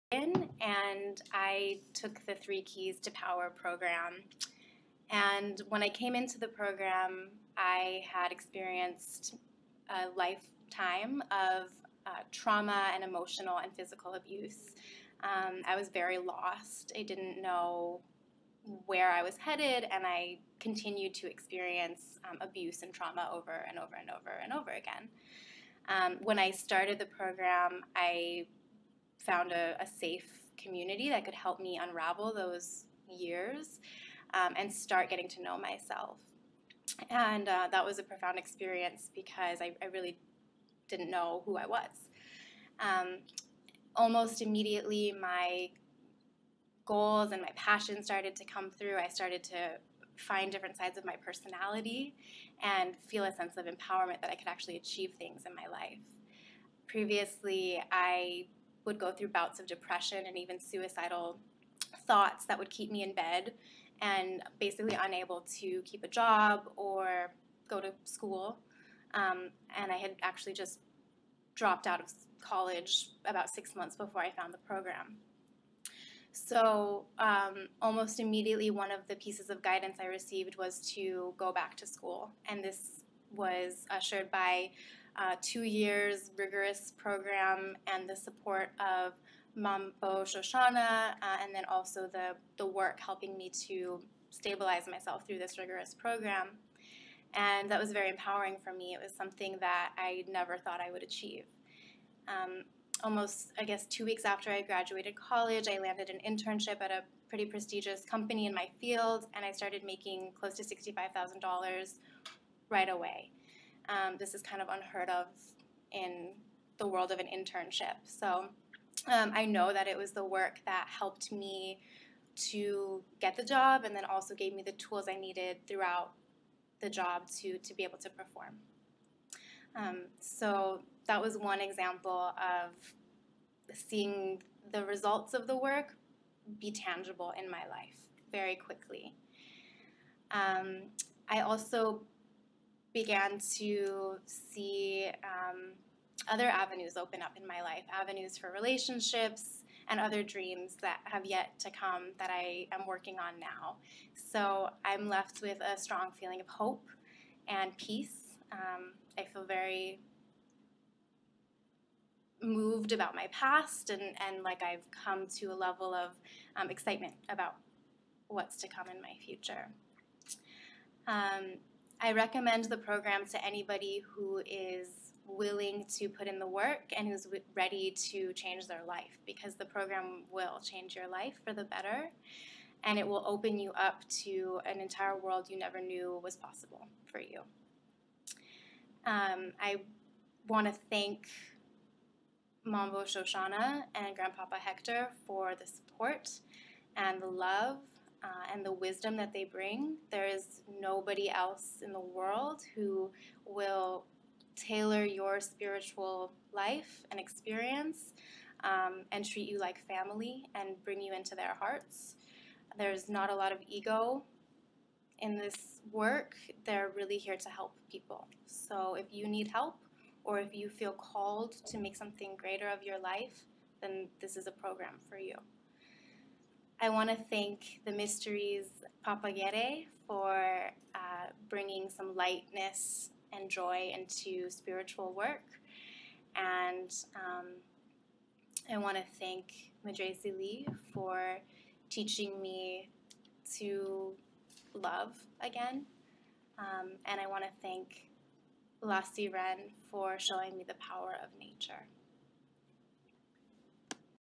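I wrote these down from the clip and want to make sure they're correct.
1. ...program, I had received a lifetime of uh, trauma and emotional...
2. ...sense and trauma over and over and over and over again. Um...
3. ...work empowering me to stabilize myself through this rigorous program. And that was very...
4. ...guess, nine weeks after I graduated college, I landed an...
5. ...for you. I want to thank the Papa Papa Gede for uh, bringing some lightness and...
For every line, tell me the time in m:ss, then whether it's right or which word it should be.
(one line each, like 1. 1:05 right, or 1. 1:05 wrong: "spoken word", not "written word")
1. 0:06 wrong: "experienced", not "received"
2. 0:22 wrong: "abuse", not "sense"
3. 1:32 wrong: "helping", not "empowering"
4. 1:43 wrong: "two", not "nine"
5. 3:45 wrong: "Mysteries", not "Papa".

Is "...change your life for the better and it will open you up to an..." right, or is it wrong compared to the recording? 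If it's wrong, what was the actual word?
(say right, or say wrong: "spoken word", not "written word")
right.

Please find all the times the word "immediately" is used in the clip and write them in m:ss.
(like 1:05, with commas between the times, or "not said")
0:44, 1:18.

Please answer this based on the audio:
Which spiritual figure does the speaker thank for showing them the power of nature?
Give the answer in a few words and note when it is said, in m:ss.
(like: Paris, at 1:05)
La Sirène, at 4:08.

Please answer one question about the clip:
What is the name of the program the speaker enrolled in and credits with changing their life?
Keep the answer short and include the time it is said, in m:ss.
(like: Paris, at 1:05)
Three Keys to Power, at 0:02.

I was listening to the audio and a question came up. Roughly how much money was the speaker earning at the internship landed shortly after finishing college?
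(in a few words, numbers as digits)
$65,000.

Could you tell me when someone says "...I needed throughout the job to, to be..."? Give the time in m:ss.
2:05.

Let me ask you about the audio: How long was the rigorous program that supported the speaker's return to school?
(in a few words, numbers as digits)
two years.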